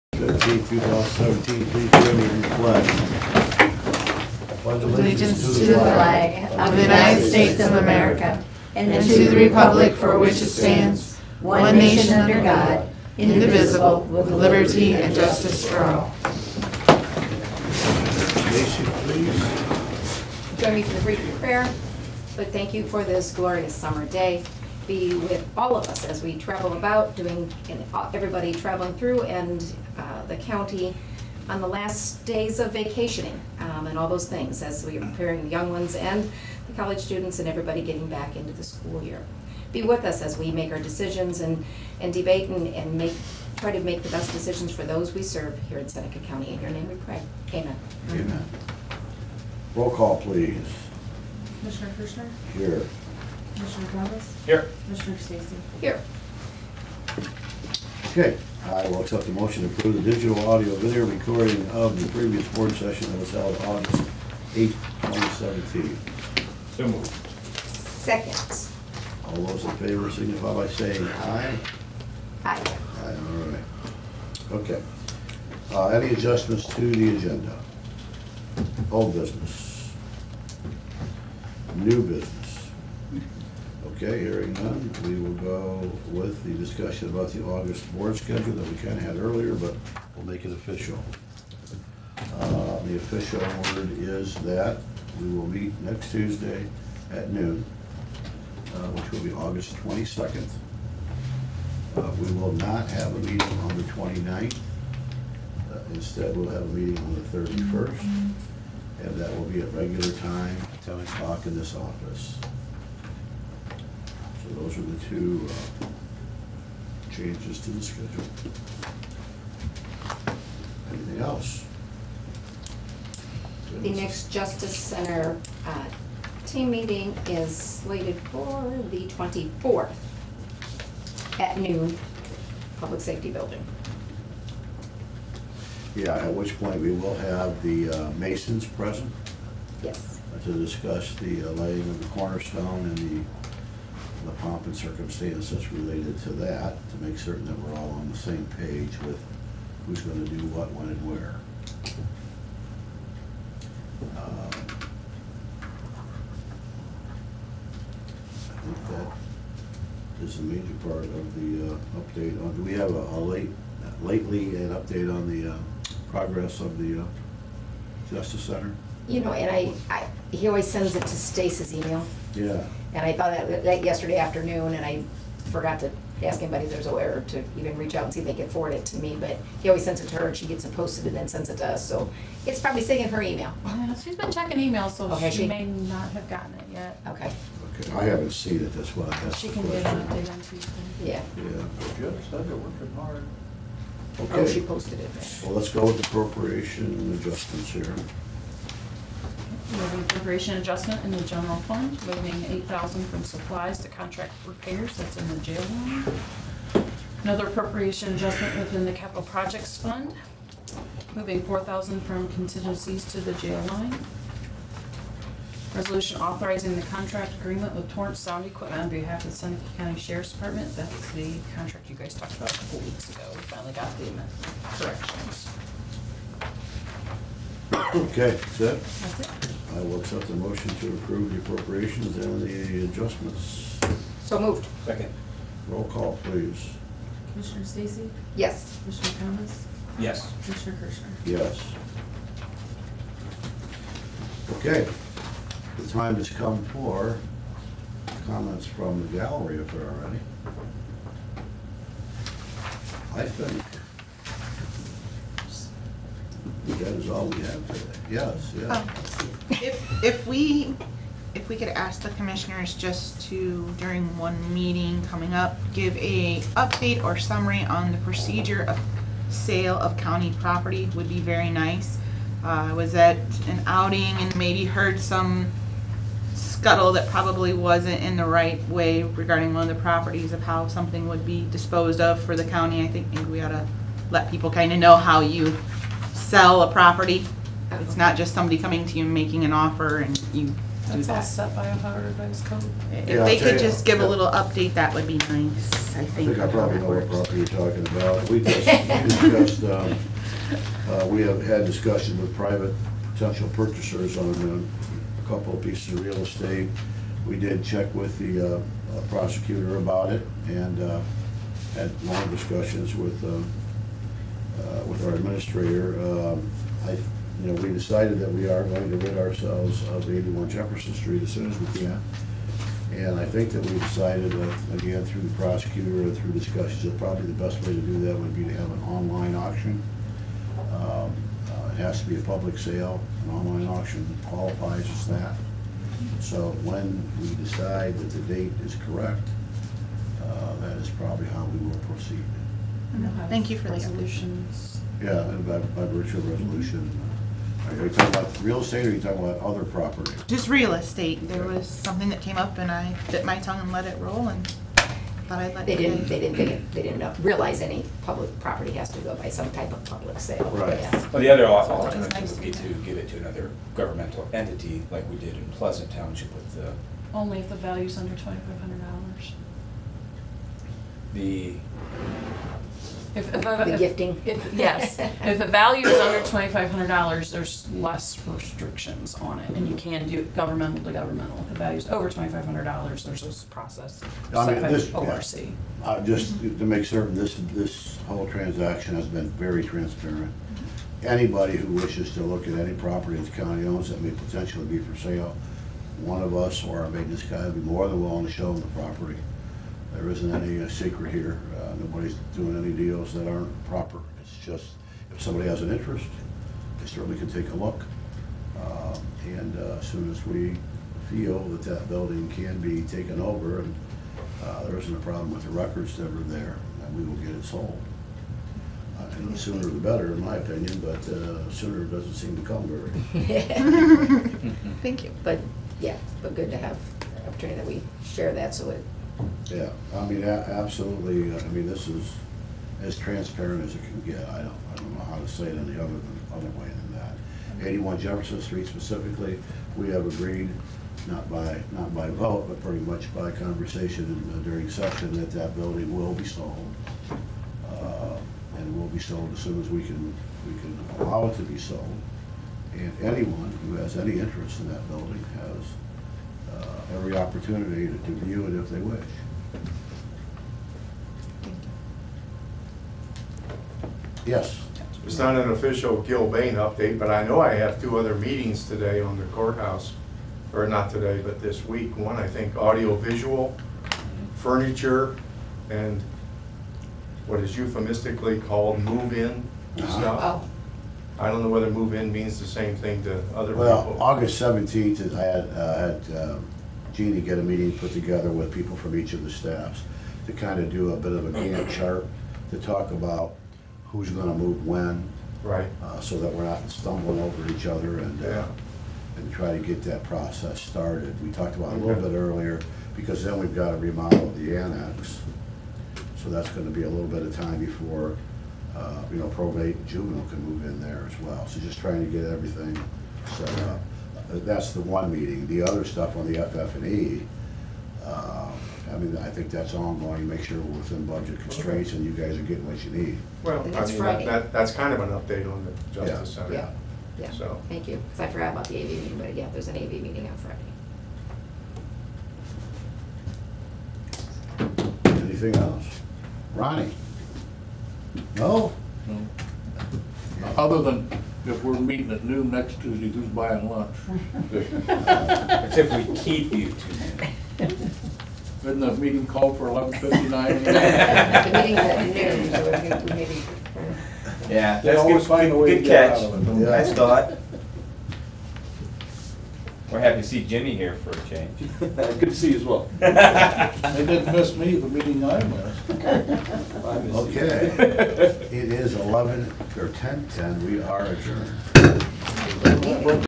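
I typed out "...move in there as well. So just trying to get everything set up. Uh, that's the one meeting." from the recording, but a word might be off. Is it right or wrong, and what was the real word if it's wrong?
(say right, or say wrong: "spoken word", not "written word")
right.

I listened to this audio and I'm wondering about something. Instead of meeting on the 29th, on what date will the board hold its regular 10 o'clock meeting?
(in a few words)
31st.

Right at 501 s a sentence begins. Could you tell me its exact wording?
We talked about it a little bit earlier, because then we've got to remodel the annex.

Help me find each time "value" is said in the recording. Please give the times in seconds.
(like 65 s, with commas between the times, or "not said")
367 s, 375 s.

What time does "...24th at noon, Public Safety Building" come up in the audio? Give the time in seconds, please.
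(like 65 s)
129 s.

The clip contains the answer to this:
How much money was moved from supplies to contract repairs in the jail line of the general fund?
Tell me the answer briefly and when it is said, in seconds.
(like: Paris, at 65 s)
$8,000, at 202 s.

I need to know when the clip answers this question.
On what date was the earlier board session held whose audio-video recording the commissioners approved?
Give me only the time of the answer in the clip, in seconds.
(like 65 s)
63 s.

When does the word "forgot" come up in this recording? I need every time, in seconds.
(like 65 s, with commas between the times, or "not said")
175 s, 528 s.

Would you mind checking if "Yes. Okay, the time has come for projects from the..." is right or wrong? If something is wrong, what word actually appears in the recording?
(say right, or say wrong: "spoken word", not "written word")
wrong: "comments", not "projects".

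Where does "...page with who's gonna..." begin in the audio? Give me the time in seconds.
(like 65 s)
148 s.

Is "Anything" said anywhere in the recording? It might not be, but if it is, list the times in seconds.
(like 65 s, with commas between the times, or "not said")
120 s, 535 s.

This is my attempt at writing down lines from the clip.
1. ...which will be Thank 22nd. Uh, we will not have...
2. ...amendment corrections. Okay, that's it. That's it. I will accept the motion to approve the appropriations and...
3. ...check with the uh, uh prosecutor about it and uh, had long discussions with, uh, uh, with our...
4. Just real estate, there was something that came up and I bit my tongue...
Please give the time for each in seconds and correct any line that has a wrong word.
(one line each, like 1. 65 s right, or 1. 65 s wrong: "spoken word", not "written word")
1. 98 s wrong: "August", not "Thank"
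2. 224 s right
3. 307 s right
4. 350 s right.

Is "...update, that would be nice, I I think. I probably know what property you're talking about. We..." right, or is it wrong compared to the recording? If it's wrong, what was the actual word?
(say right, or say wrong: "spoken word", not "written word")
right.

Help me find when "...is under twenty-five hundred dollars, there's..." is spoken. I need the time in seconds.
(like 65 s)
375 s.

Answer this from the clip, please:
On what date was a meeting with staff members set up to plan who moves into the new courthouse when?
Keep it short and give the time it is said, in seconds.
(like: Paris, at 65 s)
August 17, at 484 s.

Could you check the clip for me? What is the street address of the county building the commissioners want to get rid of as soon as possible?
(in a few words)
81 Jefferson Street.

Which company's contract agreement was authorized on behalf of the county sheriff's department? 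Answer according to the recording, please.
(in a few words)
Torrance Sound Equipment.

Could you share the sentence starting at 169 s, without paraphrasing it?
You know, and I, I, he always sends it to Stacey's email.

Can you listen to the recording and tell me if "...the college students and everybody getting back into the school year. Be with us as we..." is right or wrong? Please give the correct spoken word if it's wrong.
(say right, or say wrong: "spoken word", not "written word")
right.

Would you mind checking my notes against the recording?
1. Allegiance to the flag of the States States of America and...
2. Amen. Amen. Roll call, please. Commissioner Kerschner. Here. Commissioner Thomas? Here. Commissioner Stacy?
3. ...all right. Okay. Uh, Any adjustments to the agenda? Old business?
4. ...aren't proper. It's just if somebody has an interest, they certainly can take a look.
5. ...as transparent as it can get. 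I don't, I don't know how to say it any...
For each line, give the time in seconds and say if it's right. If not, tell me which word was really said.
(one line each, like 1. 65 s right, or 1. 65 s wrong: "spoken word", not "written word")
1. 4 s wrong: "United", not "States"
2. 47 s right
3. 73 s right
4. 403 s right
5. 432 s right.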